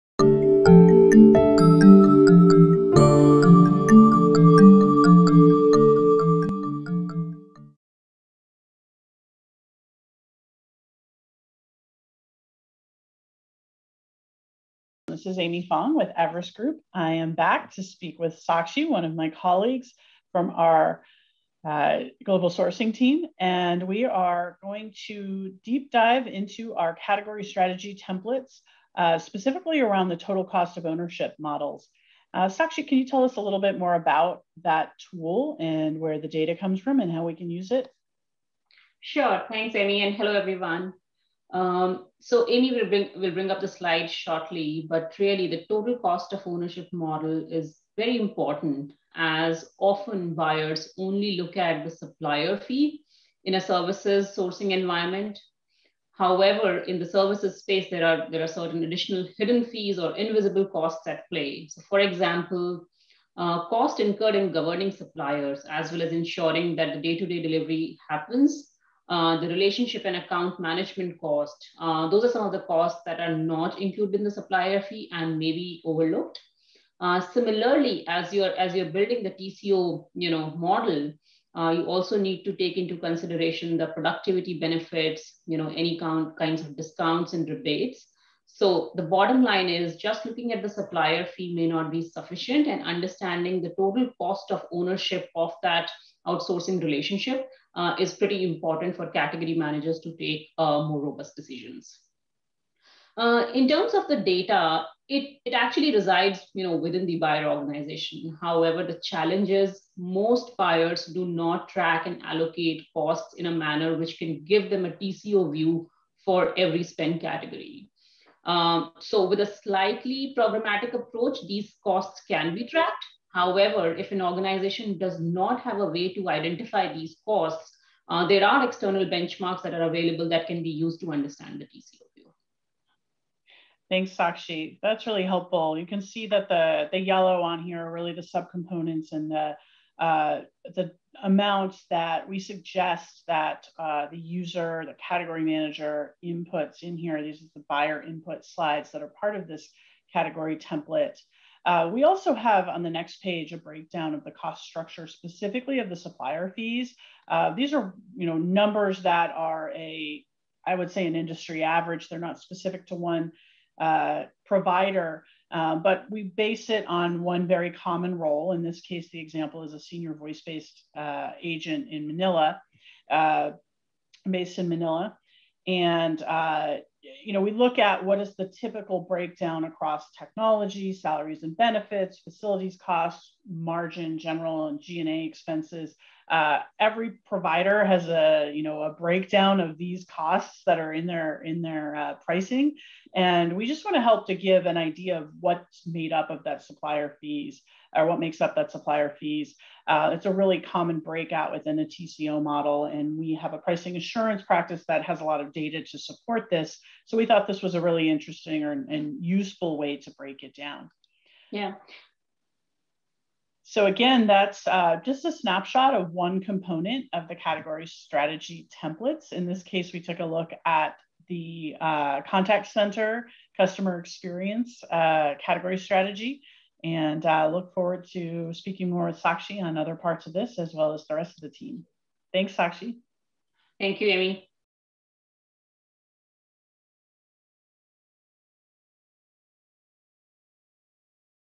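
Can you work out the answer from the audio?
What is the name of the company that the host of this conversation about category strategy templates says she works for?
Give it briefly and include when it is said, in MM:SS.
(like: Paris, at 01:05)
Everest Group, at 00:16.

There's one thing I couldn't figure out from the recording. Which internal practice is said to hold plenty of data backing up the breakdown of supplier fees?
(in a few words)
pricing assurance practice.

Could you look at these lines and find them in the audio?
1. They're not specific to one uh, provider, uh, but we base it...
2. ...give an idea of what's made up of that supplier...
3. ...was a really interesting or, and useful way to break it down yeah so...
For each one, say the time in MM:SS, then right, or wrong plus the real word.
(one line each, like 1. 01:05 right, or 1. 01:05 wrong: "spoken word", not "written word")
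1. 02:42 right
2. 03:14 right
3. 03:27 right.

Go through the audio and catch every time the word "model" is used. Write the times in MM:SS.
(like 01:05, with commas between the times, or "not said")
00:31, 00:46, 01:20, 03:22.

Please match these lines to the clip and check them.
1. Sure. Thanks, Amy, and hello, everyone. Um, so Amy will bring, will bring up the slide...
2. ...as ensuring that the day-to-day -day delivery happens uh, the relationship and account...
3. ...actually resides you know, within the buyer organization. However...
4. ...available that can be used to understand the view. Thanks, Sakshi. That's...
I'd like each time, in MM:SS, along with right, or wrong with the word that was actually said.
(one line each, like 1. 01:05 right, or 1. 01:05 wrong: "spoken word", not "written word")
1. 00:39 right
2. 01:06 right
3. 01:45 right
4. 02:09 right.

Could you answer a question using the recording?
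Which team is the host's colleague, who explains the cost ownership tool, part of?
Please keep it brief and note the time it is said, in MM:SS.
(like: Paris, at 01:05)
global sourcing team, at 00:22.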